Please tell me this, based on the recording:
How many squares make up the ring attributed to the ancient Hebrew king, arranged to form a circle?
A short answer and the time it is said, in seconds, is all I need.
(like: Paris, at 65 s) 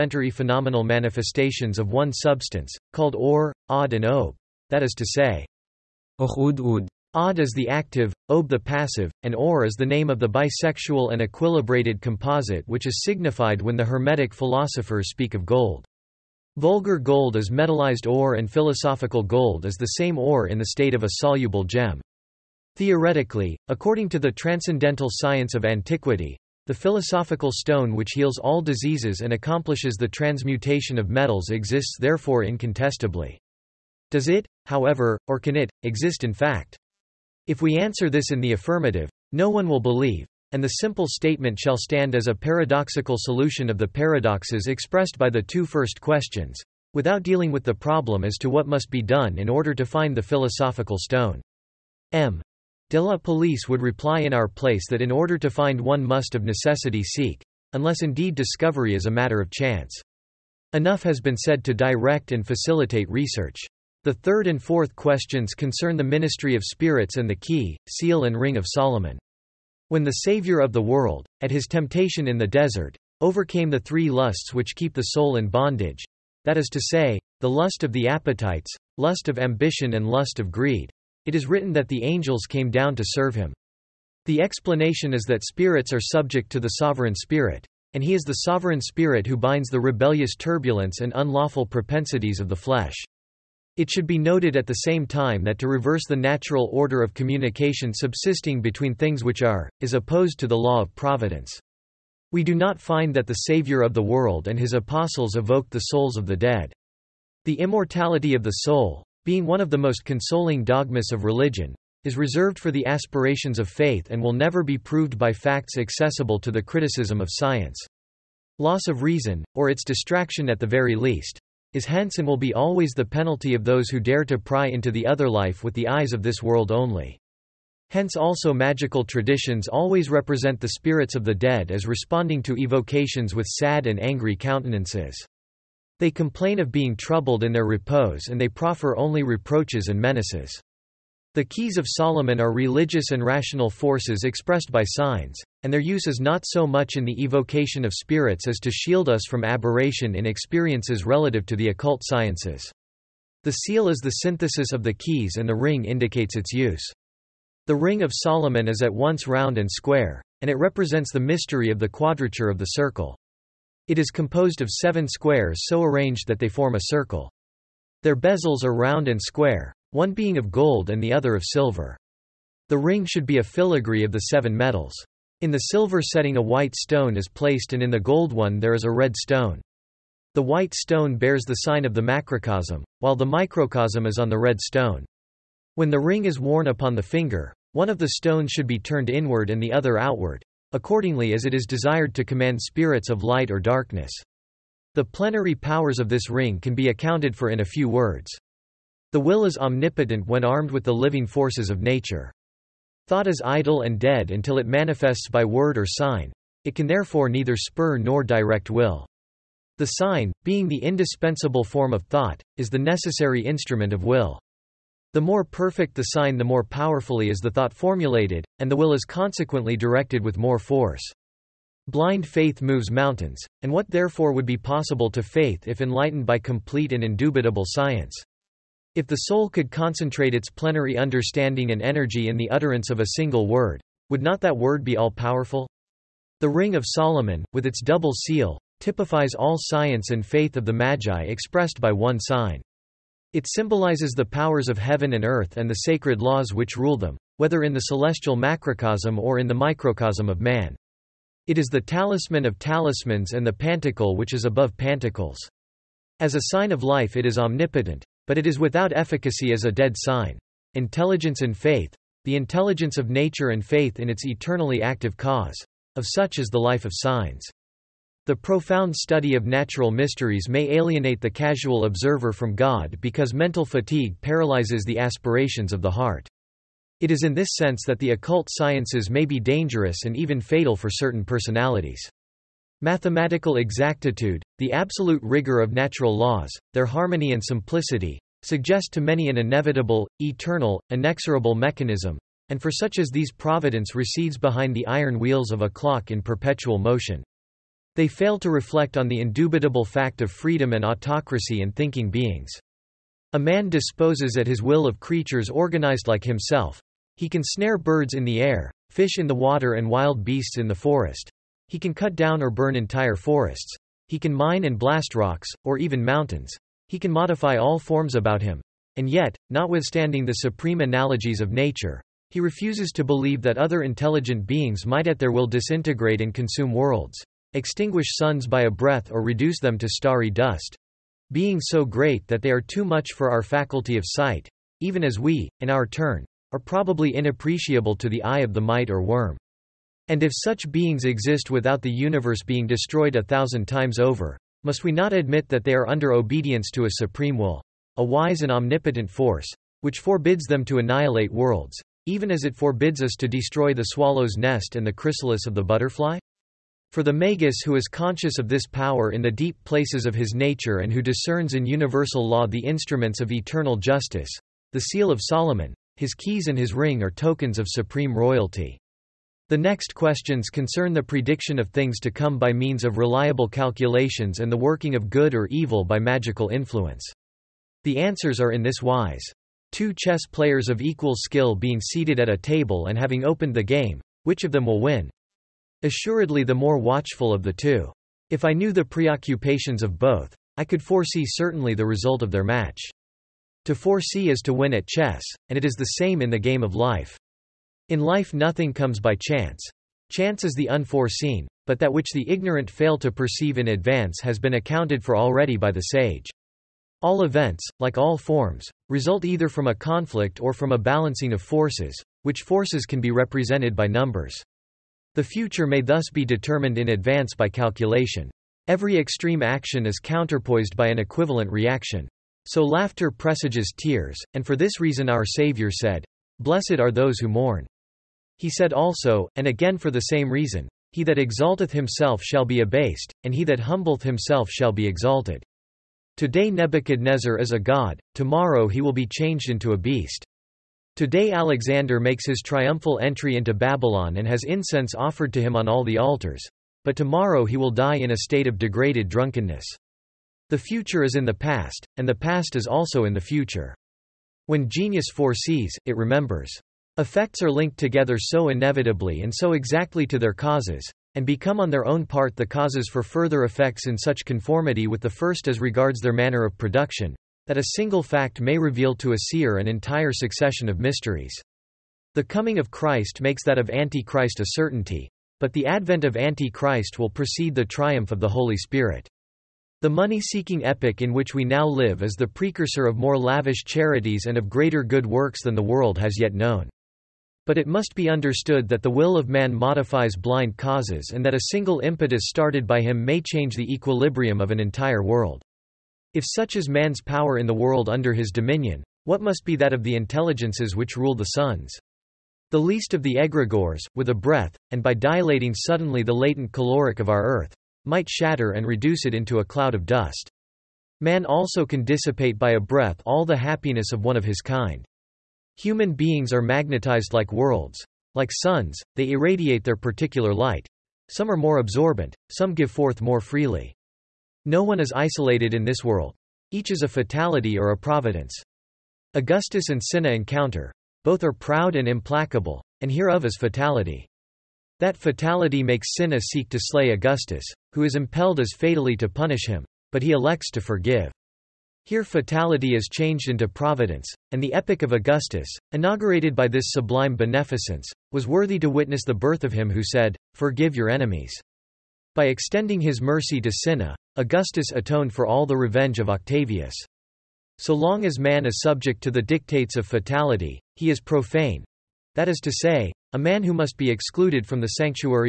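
7, at 164 s.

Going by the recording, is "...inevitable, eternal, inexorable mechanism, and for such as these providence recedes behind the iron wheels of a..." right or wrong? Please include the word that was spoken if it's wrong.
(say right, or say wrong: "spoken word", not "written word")
right.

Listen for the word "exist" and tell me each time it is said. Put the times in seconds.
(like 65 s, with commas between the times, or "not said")
31 s, 35 s, 341 s.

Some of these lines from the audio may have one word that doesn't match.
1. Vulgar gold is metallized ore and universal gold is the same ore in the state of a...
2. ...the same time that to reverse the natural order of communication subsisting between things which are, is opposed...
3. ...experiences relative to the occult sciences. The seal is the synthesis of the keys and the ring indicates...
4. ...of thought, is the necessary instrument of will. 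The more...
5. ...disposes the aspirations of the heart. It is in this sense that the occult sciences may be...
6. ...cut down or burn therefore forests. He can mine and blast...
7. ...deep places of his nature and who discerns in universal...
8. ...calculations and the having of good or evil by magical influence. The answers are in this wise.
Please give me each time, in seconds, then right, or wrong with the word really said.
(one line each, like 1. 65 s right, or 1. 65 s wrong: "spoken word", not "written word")
1. 16 s wrong: "philosophical", not "universal"
2. 94 s right
3. 150 s right
4. 211 s right
5. 274 s wrong: "paralyzes", not "disposes"
6. 311 s wrong: "entire", not "therefore"
7. 359 s right
8. 373 s wrong: "working", not "having".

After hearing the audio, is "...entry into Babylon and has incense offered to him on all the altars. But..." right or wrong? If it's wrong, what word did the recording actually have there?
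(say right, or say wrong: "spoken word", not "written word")
right.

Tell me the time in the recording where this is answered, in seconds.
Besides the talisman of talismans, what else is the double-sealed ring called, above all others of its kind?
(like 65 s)
253 s.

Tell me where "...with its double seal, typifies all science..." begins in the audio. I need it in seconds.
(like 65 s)
237 s.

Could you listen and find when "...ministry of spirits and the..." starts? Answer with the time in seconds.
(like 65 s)
66 s.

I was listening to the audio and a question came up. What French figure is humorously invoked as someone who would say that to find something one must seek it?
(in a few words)
M. De la Palisse.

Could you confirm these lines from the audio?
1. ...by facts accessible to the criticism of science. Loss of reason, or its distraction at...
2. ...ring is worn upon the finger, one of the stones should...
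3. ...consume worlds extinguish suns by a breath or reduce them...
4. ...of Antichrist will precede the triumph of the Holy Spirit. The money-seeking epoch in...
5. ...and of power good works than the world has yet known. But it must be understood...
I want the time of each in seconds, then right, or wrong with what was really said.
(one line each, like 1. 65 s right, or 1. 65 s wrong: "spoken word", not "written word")
1. 115 s right
2. 185 s right
3. 326 s right
4. 476 s right
5. 484 s wrong: "greater", not "power".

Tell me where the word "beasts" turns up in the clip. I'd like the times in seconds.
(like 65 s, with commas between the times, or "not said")
310 s, 439 s.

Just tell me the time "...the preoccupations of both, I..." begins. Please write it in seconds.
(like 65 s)
388 s.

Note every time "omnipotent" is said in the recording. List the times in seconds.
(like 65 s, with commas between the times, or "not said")
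199 s, 257 s, 348 s.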